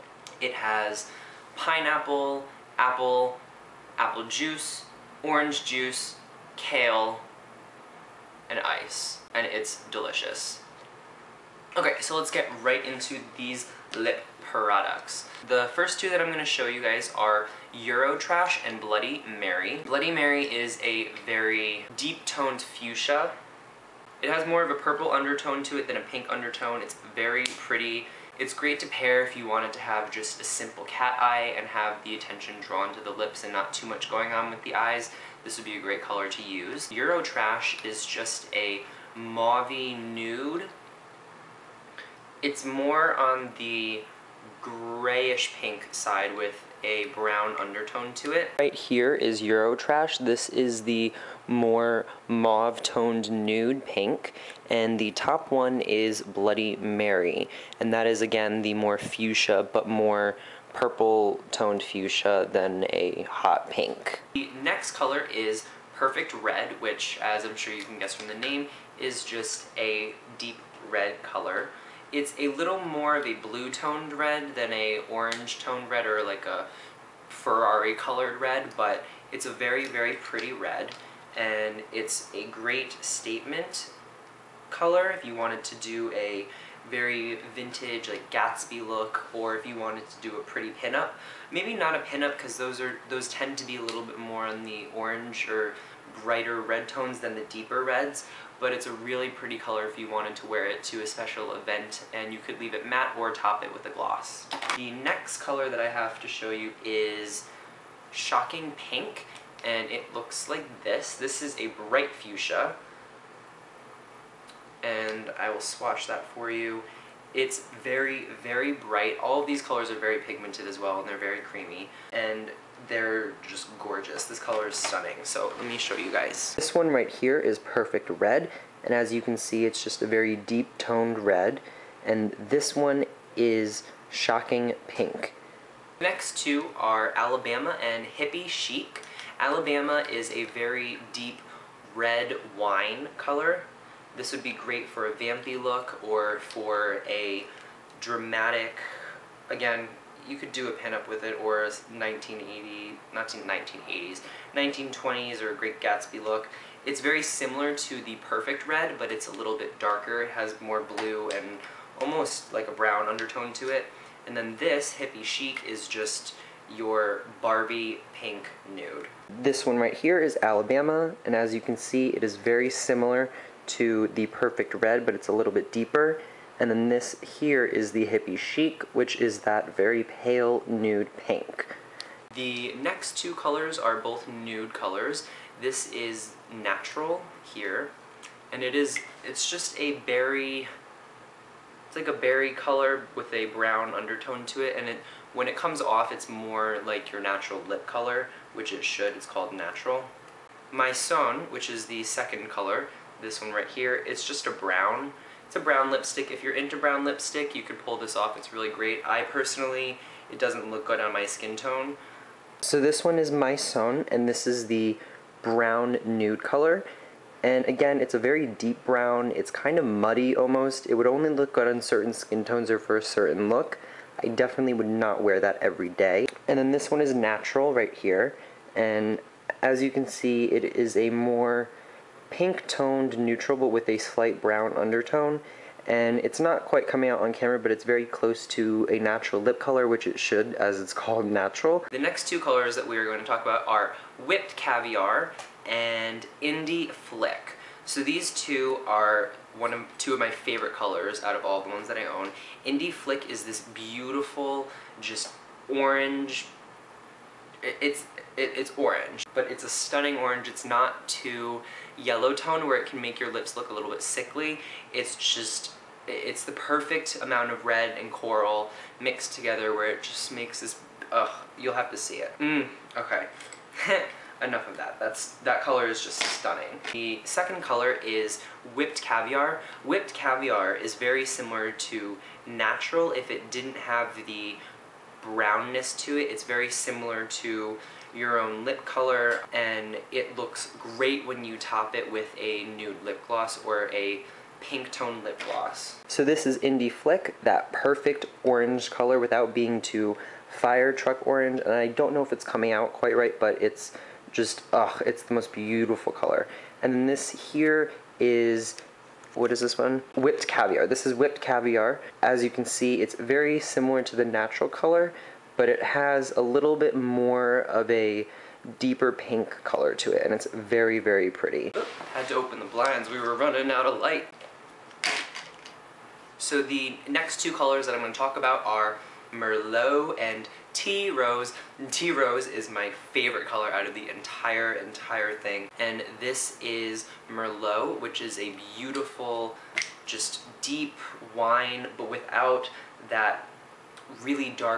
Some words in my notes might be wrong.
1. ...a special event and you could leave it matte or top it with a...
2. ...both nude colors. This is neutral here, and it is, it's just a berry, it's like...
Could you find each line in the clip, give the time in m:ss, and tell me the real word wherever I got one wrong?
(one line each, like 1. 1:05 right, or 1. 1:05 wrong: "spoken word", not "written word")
1. 1:41 right
2. 3:04 wrong: "natural", not "neutral".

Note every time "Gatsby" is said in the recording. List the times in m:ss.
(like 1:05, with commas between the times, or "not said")
1:28, 2:35.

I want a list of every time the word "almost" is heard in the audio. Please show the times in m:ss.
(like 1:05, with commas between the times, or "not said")
2:42, 3:40.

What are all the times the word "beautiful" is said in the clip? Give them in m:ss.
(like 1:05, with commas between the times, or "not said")
4:13, 5:05, 5:38.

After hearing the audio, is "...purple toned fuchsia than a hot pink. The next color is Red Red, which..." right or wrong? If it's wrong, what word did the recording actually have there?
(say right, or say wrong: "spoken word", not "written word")
wrong: "Perfect", not "Red".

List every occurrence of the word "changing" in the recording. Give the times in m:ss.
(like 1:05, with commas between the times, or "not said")
not said.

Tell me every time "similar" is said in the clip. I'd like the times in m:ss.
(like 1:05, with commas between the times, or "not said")
2:37, 2:52, 4:41, 4:46, 5:13.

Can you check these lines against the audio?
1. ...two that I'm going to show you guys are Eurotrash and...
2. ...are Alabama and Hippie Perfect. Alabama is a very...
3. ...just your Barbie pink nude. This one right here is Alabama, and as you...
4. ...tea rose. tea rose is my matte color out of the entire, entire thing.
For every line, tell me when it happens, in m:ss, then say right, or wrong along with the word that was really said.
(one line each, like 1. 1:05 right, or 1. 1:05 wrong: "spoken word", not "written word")
1. 0:15 right
2. 2:16 wrong: "Chic", not "Perfect"
3. 2:45 right
4. 5:30 wrong: "favorite", not "matte".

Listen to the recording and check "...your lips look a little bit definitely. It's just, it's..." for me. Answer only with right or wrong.
wrong.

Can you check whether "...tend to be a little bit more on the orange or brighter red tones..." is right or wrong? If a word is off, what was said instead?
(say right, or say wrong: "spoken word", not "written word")
right.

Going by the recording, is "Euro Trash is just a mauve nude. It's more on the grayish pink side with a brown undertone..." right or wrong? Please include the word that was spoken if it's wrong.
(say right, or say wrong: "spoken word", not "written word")
right.